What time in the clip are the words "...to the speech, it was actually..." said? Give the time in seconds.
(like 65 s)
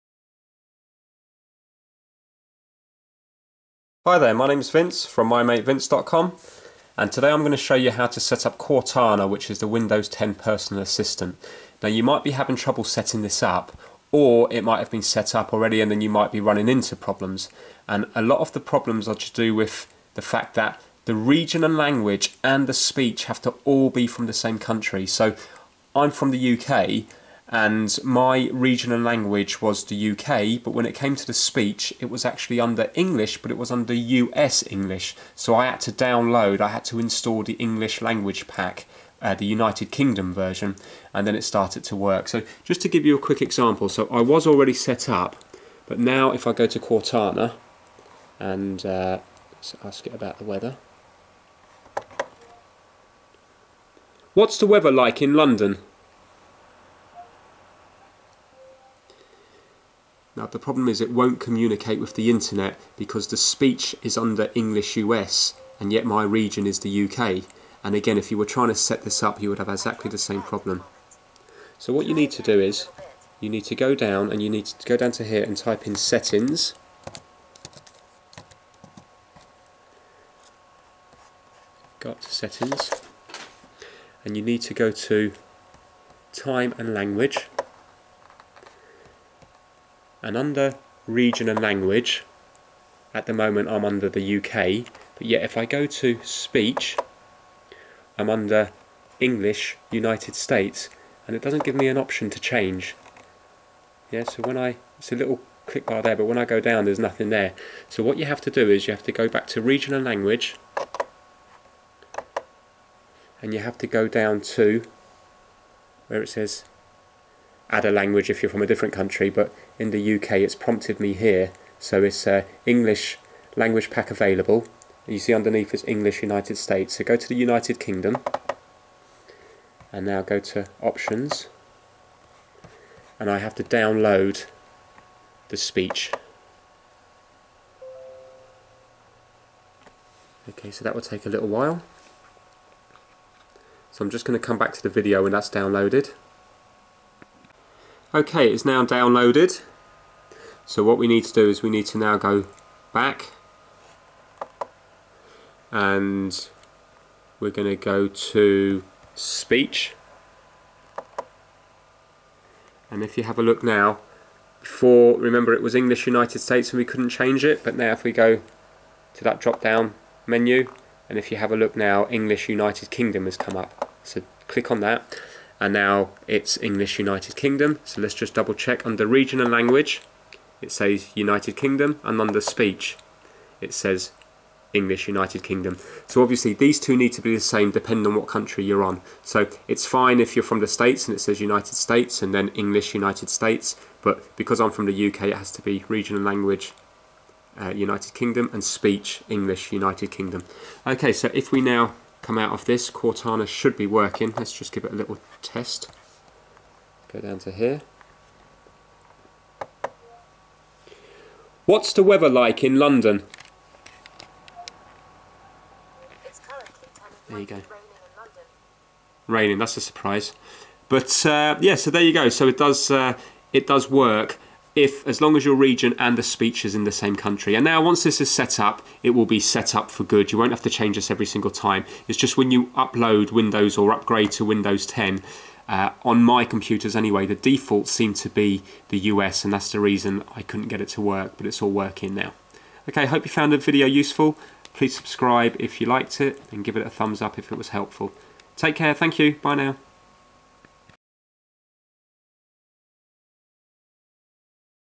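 31 s.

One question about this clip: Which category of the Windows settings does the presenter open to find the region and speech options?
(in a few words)
Time and language.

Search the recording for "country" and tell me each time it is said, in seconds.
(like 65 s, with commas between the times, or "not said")
24 s, 118 s, 188 s, 227 s.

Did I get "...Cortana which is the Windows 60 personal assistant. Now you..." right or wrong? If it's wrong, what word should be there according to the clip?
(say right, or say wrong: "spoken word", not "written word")
wrong: "10", not "60".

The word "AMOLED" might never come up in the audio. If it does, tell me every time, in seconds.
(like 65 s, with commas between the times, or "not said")
not said.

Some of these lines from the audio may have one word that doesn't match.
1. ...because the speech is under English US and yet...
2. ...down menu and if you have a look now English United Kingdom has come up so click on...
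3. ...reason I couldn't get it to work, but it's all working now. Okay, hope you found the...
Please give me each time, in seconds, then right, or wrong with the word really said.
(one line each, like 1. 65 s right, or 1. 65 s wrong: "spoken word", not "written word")
1. 62 s right
2. 169 s right
3. 239 s right.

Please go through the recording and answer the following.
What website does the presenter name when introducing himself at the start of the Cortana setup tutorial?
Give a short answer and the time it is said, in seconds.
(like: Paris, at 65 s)
mymatevince.com, at 5 s.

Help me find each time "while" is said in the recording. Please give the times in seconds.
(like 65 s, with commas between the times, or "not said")
141 s.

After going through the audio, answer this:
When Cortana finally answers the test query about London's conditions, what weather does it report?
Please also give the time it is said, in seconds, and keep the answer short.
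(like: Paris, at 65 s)
Raining, at 219 s.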